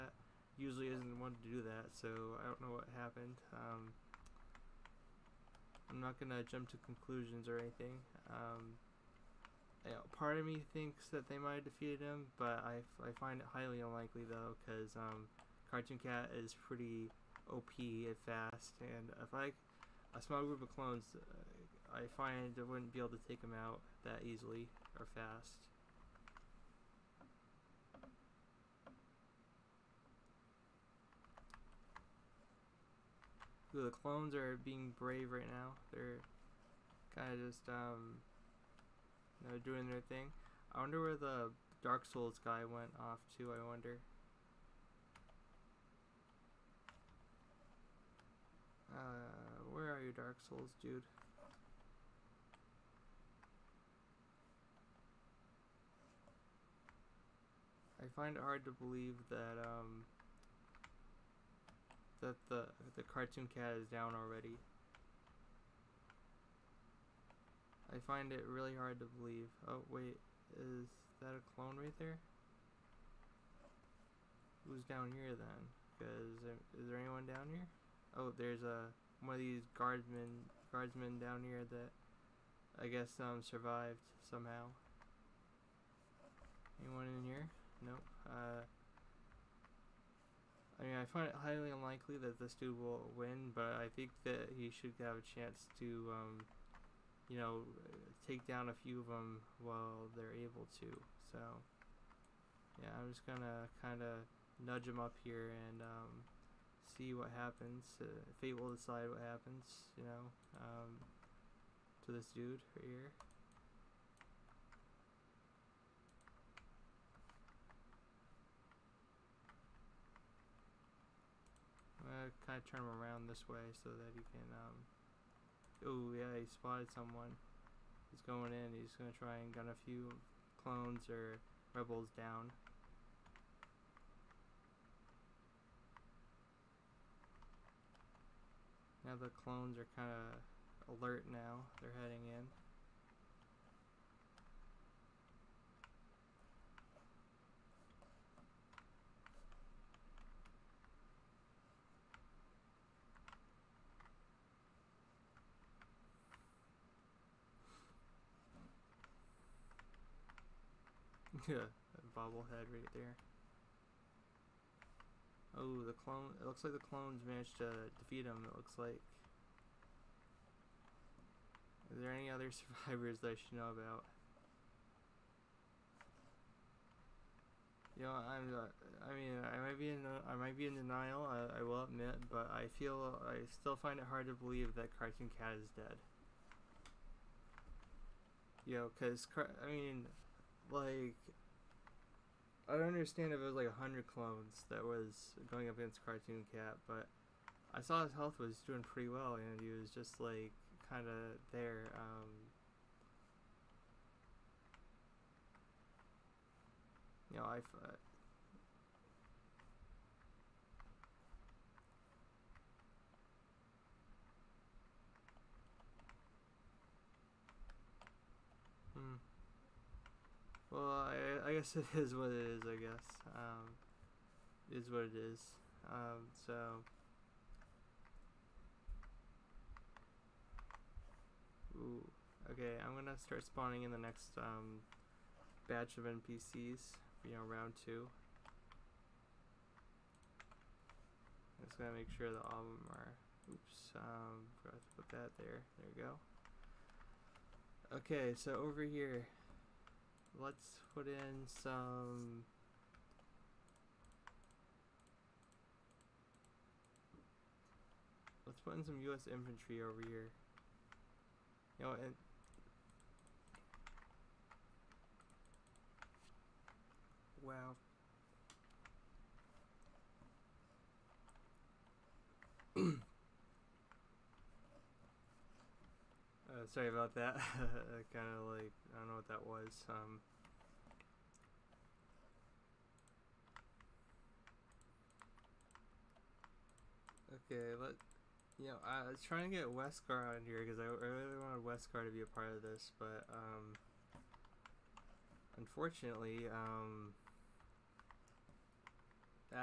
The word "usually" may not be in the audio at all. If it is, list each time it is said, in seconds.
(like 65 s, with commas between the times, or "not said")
0 s.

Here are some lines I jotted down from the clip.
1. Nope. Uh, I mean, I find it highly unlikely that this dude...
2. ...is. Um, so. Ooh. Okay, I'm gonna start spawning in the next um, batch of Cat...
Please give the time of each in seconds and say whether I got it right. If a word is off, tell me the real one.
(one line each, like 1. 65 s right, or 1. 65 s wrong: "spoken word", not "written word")
1. 87 s right
2. 225 s wrong: "NPCs", not "Cat".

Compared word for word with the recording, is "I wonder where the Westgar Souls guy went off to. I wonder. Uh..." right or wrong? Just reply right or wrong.
wrong.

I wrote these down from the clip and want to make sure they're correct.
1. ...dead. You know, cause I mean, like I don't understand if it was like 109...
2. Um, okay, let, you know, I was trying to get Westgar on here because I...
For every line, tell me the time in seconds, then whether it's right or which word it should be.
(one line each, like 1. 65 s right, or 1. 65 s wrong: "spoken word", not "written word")
1. 185 s wrong: "100", not "109"
2. 279 s right.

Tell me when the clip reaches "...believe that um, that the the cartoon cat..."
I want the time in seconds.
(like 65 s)
58 s.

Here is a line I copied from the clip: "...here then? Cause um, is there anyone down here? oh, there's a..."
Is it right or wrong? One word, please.
right.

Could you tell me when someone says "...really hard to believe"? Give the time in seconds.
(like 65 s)
68 s.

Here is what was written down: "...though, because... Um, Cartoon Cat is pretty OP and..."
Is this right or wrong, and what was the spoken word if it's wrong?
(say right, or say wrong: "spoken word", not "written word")
right.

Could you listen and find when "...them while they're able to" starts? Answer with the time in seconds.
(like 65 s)
99 s.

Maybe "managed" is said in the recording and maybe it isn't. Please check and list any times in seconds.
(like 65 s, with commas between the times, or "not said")
167 s.